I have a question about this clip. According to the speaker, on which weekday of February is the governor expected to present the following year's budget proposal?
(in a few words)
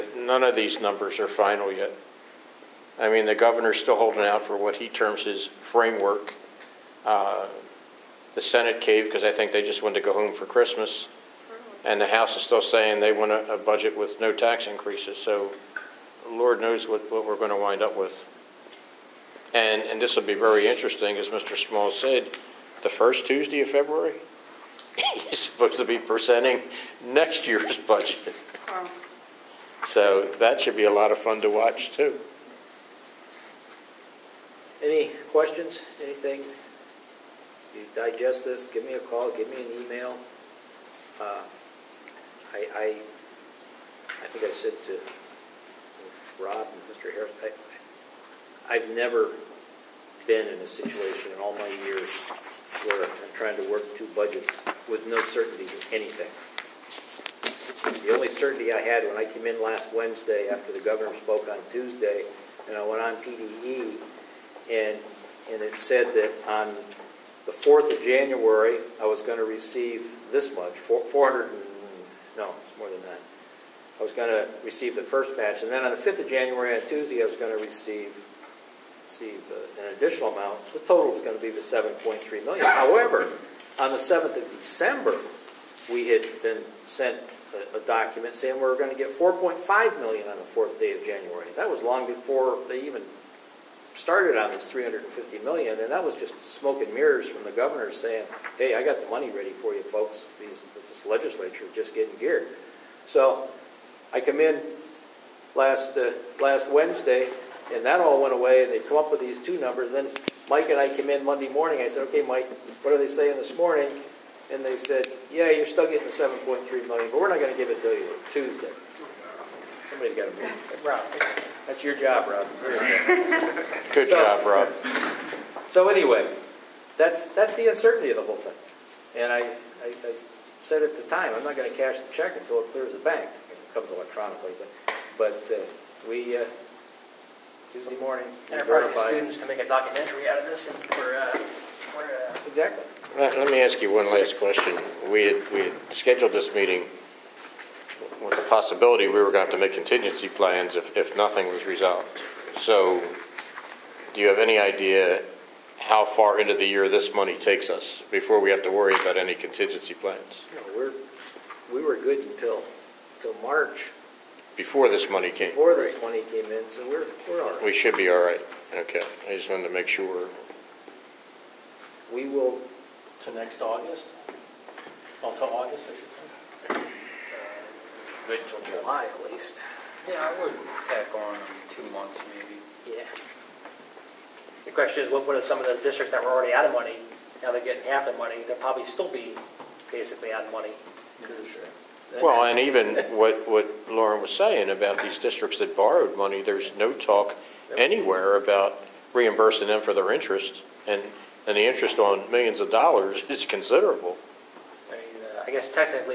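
first Tuesday.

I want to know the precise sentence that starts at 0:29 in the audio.
So that should be a lot of fun to watch, too.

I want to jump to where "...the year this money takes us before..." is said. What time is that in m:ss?
2:36.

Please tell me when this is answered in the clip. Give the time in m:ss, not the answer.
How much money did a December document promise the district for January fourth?
1:29.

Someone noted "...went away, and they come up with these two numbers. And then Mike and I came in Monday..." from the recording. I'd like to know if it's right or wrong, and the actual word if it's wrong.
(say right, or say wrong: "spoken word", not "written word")
right.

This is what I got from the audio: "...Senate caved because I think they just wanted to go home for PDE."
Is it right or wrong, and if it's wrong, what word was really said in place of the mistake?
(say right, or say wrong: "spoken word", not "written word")
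wrong: "Christmas", not "PDE".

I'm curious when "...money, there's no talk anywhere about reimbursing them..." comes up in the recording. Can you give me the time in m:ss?
3:16.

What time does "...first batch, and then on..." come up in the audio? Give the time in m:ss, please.
1:15.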